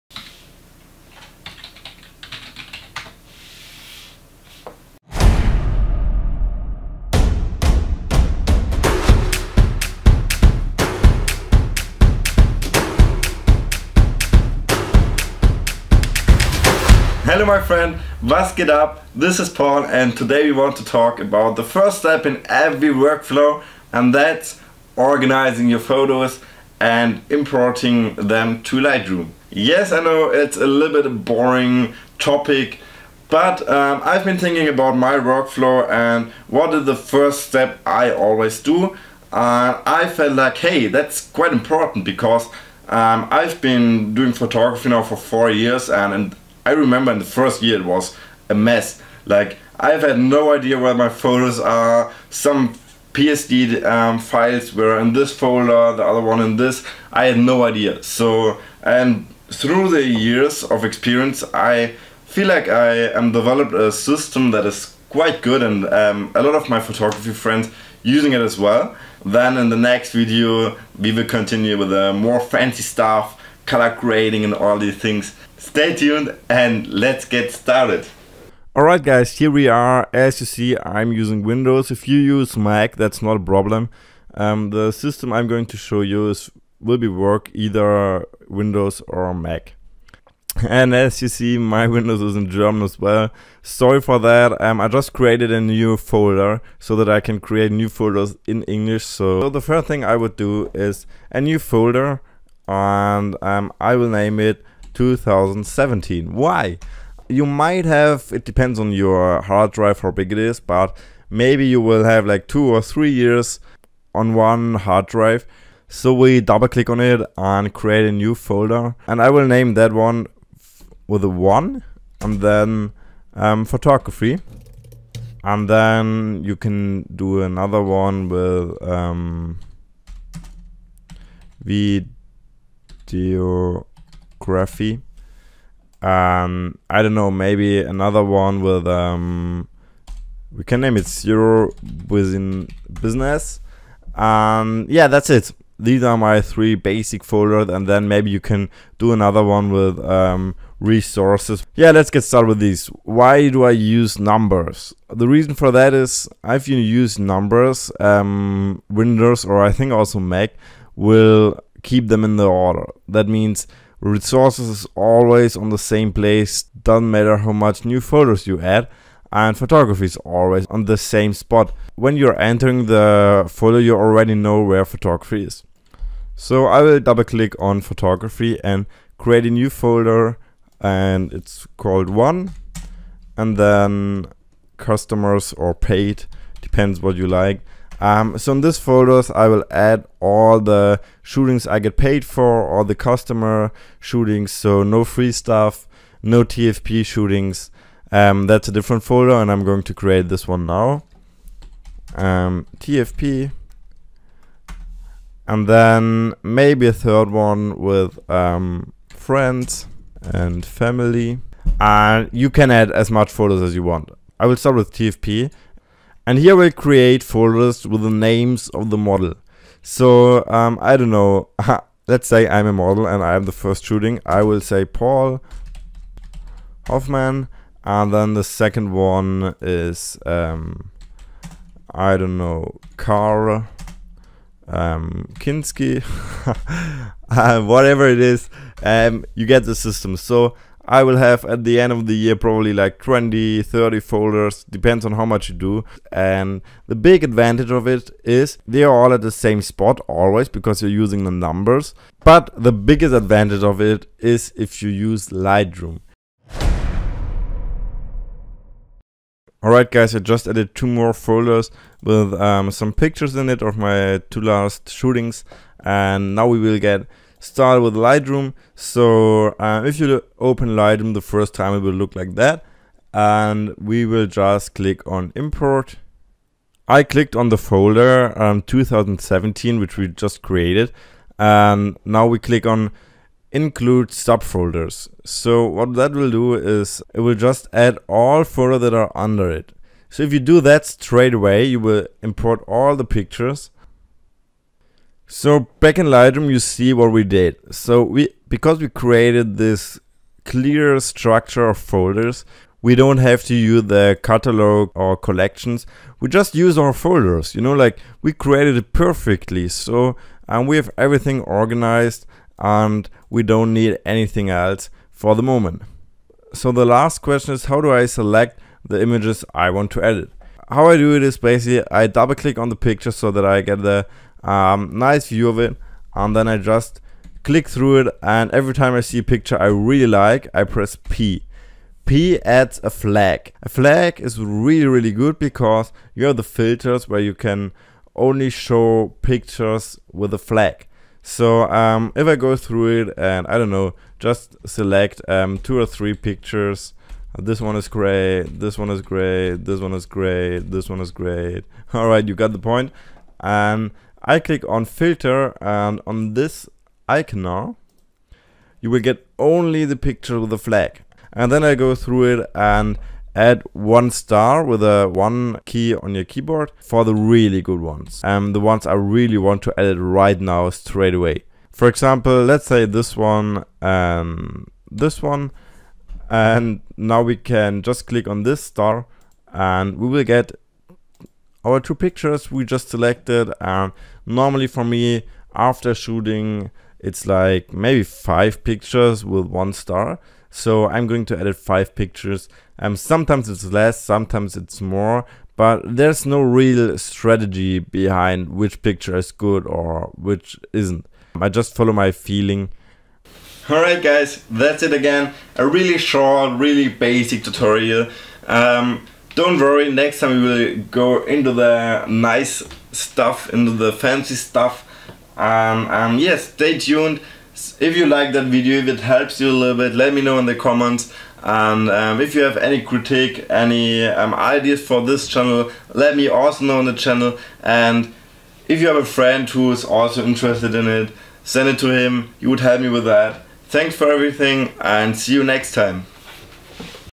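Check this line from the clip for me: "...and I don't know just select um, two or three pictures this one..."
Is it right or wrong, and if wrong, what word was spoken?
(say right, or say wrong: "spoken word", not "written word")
right.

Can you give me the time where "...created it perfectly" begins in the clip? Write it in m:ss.
5:08.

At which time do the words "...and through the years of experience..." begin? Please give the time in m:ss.
0:58.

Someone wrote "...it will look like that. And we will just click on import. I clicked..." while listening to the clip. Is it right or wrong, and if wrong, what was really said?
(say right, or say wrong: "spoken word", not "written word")
right.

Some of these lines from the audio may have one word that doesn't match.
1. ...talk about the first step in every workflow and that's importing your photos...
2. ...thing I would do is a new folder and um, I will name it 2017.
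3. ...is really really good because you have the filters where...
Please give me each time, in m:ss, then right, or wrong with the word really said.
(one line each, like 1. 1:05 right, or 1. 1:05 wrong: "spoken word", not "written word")
1. 0:20 wrong: "organizing", not "importing"
2. 1:39 right
3. 5:34 right.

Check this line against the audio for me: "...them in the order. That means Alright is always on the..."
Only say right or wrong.
wrong.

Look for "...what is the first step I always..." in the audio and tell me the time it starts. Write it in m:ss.
0:36.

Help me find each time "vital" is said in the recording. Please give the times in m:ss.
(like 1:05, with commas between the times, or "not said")
not said.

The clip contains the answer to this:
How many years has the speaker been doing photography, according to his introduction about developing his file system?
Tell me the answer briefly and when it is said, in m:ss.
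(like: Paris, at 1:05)
4, at 0:45.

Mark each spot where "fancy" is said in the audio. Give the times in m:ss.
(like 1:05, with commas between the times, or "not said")
1:12, 6:53.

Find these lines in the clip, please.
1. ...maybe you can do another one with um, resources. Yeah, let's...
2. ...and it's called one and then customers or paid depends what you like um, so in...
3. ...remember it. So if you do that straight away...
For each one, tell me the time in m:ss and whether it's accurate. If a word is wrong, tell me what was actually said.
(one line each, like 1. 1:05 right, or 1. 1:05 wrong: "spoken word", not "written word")
1. 2:28 right
2. 3:00 right
3. 4:49 wrong: "under", not "remember".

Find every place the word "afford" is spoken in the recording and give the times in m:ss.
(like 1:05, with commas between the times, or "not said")
not said.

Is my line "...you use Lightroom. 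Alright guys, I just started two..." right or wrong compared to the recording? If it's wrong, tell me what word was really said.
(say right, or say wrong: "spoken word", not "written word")
wrong: "added", not "started".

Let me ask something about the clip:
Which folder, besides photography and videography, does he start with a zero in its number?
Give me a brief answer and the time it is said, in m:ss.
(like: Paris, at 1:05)
Business, at 2:23.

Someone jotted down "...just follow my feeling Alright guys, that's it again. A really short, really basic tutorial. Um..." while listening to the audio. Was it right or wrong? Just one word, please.
right.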